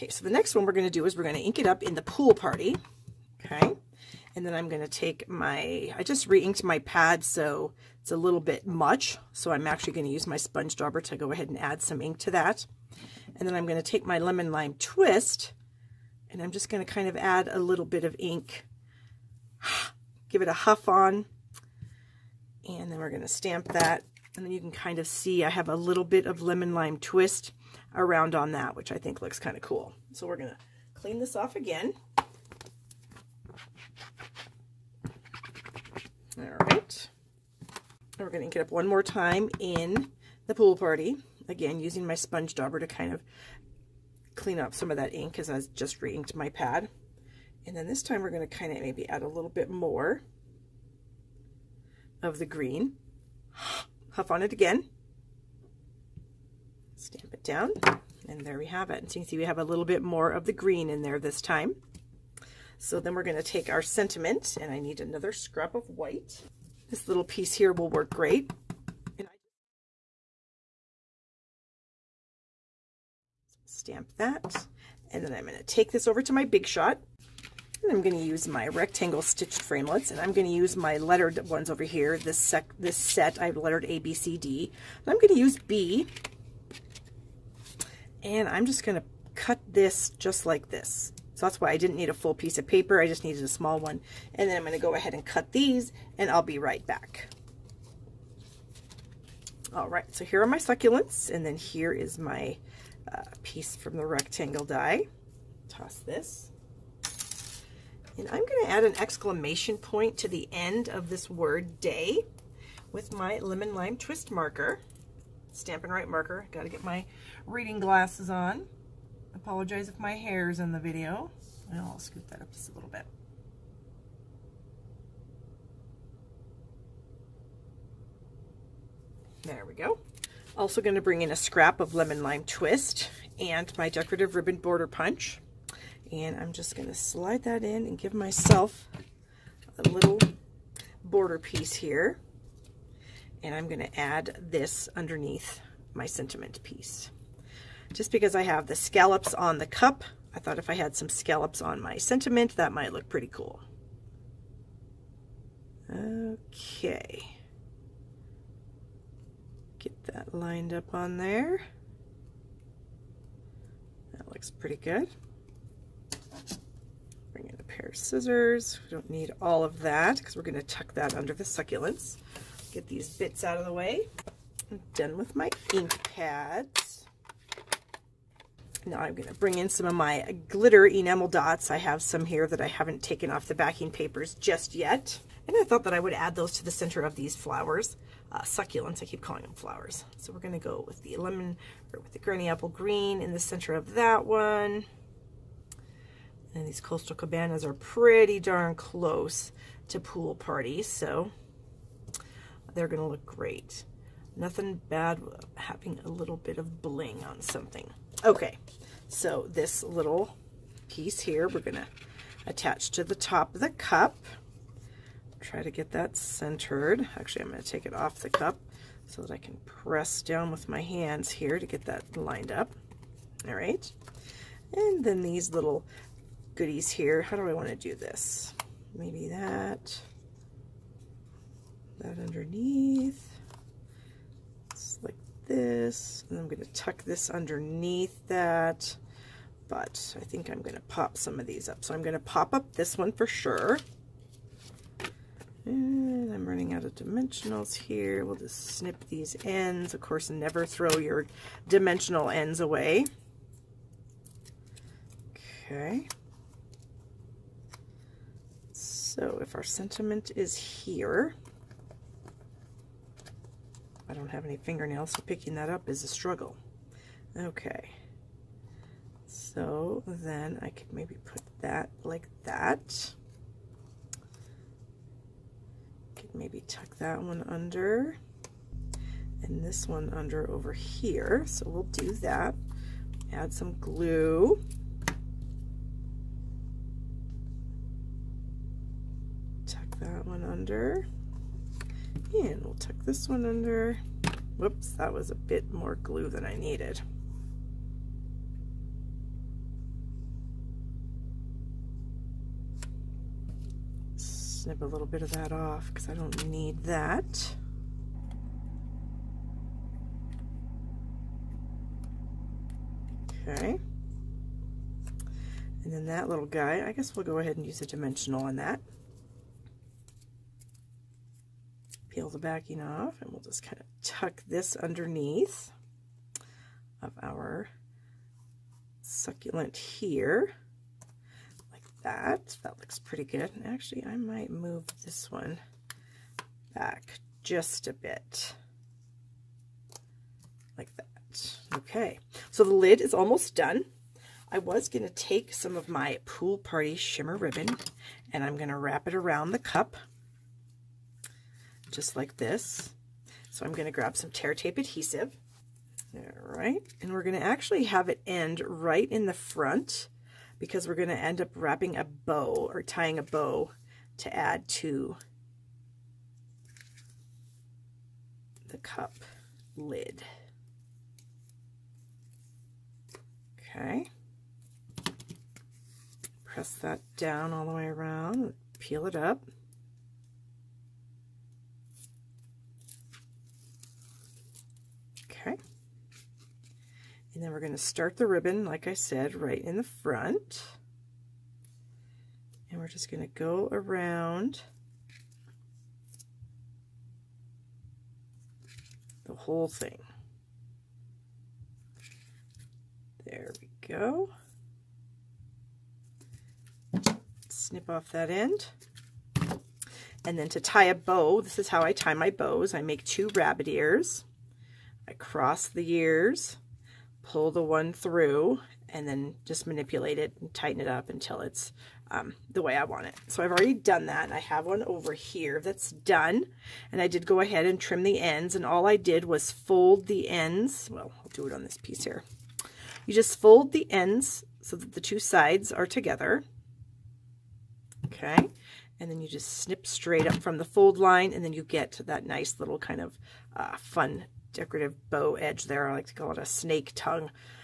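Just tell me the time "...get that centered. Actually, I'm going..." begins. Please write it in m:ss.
3:35.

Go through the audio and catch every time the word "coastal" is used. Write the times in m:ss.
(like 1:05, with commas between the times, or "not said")
3:16.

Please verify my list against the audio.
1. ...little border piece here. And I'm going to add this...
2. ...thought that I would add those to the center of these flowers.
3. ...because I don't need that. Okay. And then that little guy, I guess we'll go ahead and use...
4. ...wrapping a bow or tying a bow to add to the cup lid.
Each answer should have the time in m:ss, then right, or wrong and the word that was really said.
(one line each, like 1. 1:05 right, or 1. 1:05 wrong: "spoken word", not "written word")
1. 2:19 right
2. 3:05 right
3. 5:05 right
4. 6:01 right.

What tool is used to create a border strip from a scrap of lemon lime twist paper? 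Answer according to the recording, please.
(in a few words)
Decorative ribbon border punch.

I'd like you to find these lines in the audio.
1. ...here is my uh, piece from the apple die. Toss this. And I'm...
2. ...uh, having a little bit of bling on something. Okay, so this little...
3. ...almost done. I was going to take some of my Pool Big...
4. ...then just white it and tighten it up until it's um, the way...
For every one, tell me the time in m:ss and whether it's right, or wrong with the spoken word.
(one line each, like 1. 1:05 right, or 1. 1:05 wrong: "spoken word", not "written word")
1. 1:41 wrong: "rectangle", not "apple"
2. 3:25 right
3. 5:43 wrong: "Party", not "Big"
4. 6:59 wrong: "manipulate", not "white".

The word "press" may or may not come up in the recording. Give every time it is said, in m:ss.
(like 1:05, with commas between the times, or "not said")
3:39, 6:16.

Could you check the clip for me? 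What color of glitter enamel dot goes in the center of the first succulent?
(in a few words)
Granny apple green.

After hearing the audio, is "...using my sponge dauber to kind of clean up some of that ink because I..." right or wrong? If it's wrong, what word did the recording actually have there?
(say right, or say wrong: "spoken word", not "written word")
right.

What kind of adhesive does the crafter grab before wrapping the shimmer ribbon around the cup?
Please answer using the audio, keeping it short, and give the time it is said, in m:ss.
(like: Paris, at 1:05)
Tear tape, at 5:54.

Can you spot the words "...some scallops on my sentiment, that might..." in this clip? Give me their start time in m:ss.
2:30.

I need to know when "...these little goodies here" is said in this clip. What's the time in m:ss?
3:45.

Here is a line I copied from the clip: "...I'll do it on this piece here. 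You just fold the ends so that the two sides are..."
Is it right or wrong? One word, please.
right.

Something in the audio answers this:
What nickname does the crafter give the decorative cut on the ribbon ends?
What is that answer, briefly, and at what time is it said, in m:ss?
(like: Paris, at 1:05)
Snake tongue, at 7:26.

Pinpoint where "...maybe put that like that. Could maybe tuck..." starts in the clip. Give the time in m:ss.
4:30.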